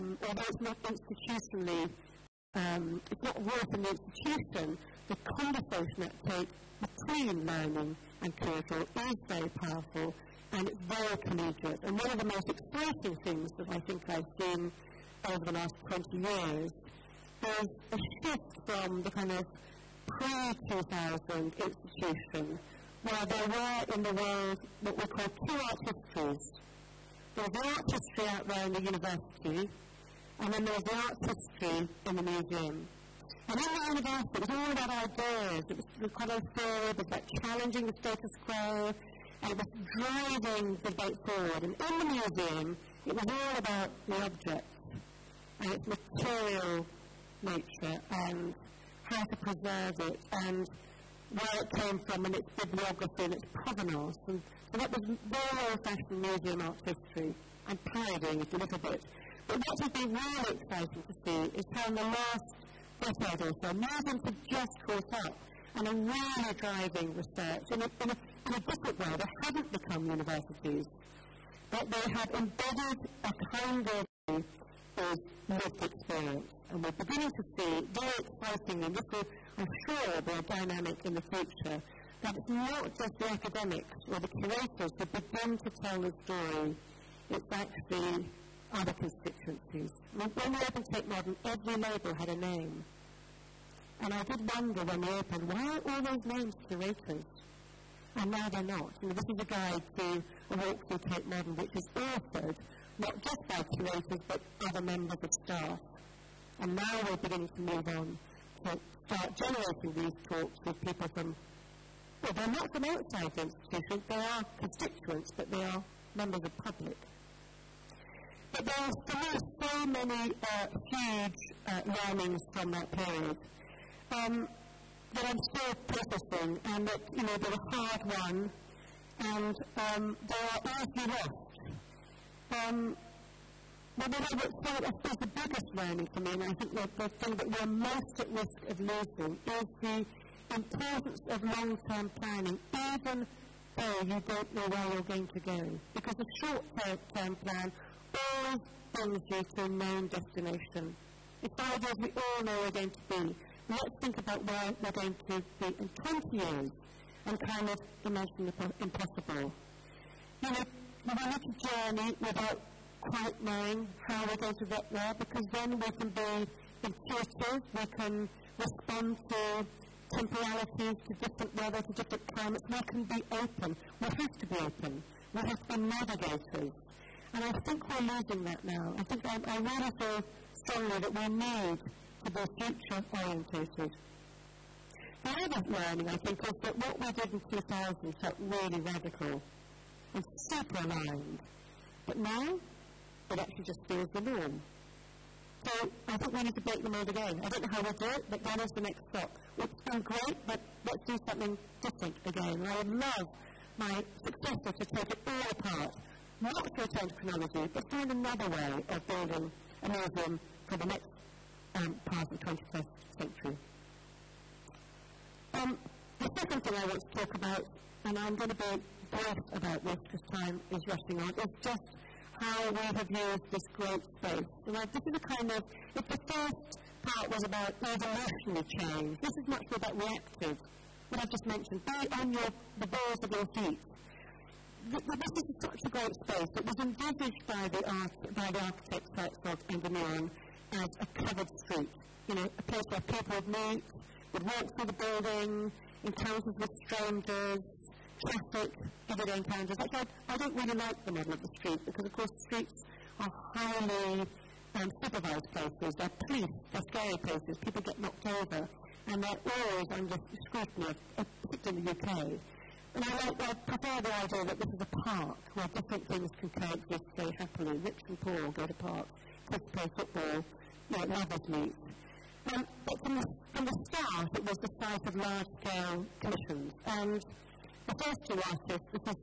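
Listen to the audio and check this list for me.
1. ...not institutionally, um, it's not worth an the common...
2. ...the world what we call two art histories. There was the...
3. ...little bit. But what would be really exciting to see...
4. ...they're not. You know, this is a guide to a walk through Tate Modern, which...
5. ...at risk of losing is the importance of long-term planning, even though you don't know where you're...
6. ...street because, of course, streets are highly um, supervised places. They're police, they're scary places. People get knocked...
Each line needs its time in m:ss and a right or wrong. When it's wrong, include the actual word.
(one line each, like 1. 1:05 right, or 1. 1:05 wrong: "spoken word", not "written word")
1. 0:00 wrong: "institution", not "common"
2. 0:24 right
3. 0:58 right
4. 1:38 right
5. 2:18 right
6. 4:11 right.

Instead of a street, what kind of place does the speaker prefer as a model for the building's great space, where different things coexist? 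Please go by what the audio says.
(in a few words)
A park.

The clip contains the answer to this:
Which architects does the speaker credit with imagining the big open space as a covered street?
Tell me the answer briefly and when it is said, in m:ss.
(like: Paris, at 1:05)
Herzog and de Meuron, at 3:59.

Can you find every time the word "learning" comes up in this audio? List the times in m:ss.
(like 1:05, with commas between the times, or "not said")
0:07, 2:01, 2:15, 3:05.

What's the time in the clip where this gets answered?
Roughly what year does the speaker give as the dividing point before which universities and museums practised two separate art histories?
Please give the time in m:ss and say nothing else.
0:20.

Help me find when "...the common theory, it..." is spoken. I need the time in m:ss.
0:35.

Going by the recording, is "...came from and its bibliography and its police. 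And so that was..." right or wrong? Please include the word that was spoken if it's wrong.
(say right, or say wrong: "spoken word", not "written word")
wrong: "provenance", not "police".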